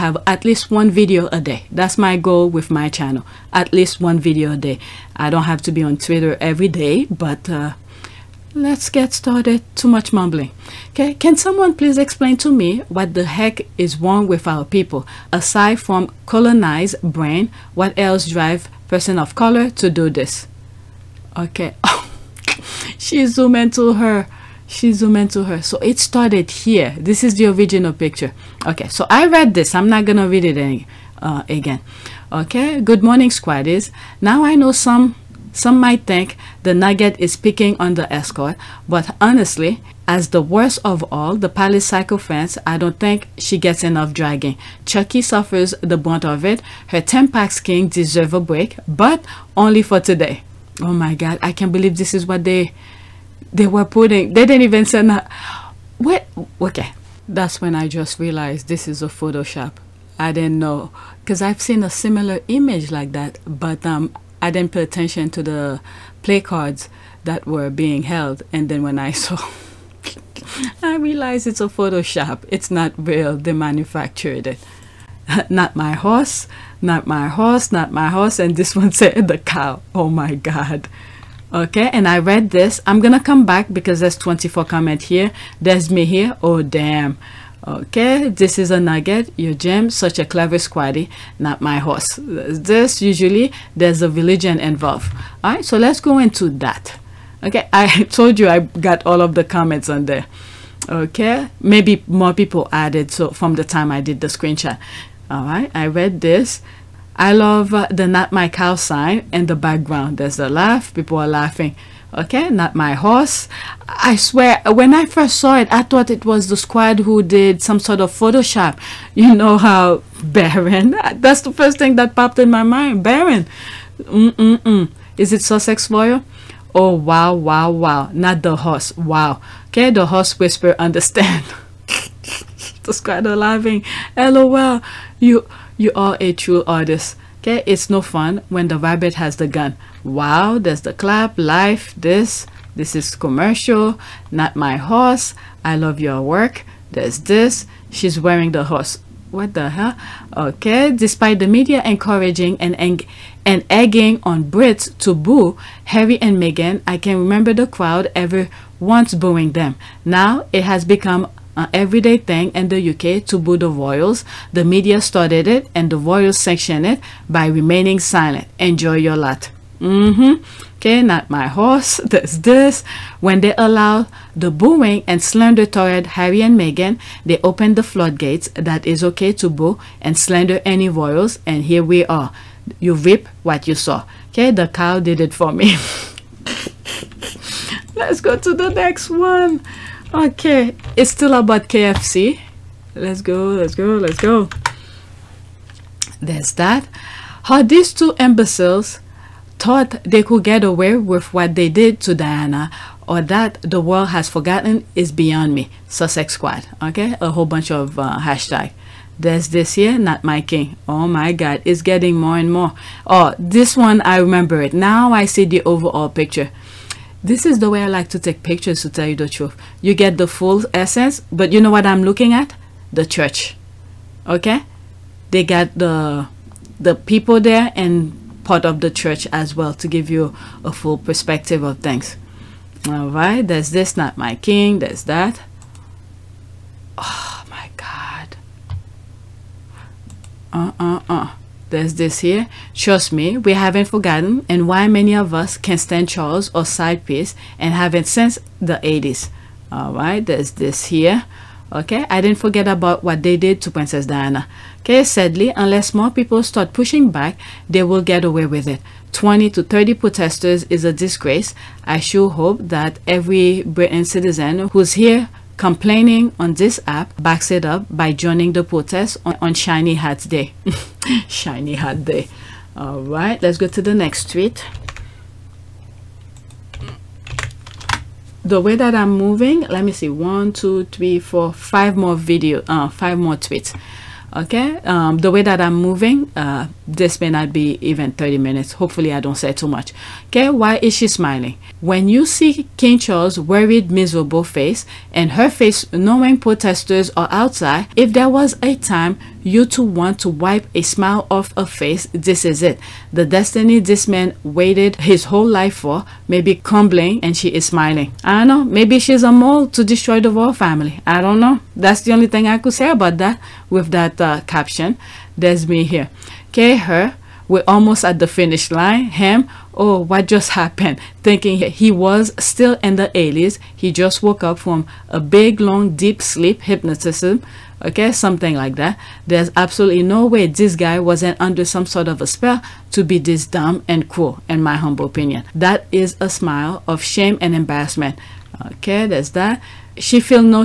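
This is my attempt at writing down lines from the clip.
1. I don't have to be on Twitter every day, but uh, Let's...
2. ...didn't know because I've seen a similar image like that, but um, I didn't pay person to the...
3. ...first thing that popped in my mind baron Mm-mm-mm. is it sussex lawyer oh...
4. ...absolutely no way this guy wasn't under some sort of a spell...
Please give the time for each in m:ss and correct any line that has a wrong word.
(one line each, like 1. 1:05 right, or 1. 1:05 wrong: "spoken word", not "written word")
1. 0:05 right
2. 1:00 wrong: "attention", not "person"
3. 2:01 right
4. 5:29 right.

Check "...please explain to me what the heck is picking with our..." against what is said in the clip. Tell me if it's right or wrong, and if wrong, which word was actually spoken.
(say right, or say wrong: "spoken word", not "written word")
wrong: "wrong", not "picking".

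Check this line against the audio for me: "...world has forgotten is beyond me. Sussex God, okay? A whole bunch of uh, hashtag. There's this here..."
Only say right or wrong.
wrong.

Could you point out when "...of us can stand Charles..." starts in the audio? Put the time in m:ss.
4:05.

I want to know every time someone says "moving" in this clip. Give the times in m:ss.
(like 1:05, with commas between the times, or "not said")
4:39, 4:45.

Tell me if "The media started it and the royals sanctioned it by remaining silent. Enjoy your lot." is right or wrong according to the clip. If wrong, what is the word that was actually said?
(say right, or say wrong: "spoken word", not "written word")
right.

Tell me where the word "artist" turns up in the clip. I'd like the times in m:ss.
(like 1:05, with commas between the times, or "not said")
2:16.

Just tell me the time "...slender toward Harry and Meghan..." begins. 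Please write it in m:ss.
2:55.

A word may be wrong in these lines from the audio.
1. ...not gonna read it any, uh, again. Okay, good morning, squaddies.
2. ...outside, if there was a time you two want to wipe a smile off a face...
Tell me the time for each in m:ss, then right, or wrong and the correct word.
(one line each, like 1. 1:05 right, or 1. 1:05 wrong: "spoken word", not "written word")
1. 0:29 right
2. 4:57 right.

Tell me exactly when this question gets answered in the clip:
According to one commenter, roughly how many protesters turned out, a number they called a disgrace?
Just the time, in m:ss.
4:19.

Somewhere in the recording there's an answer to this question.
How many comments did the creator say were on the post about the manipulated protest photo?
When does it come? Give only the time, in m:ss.
1:24.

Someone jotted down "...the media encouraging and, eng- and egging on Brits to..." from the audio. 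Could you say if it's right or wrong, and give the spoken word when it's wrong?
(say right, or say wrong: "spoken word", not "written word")
right.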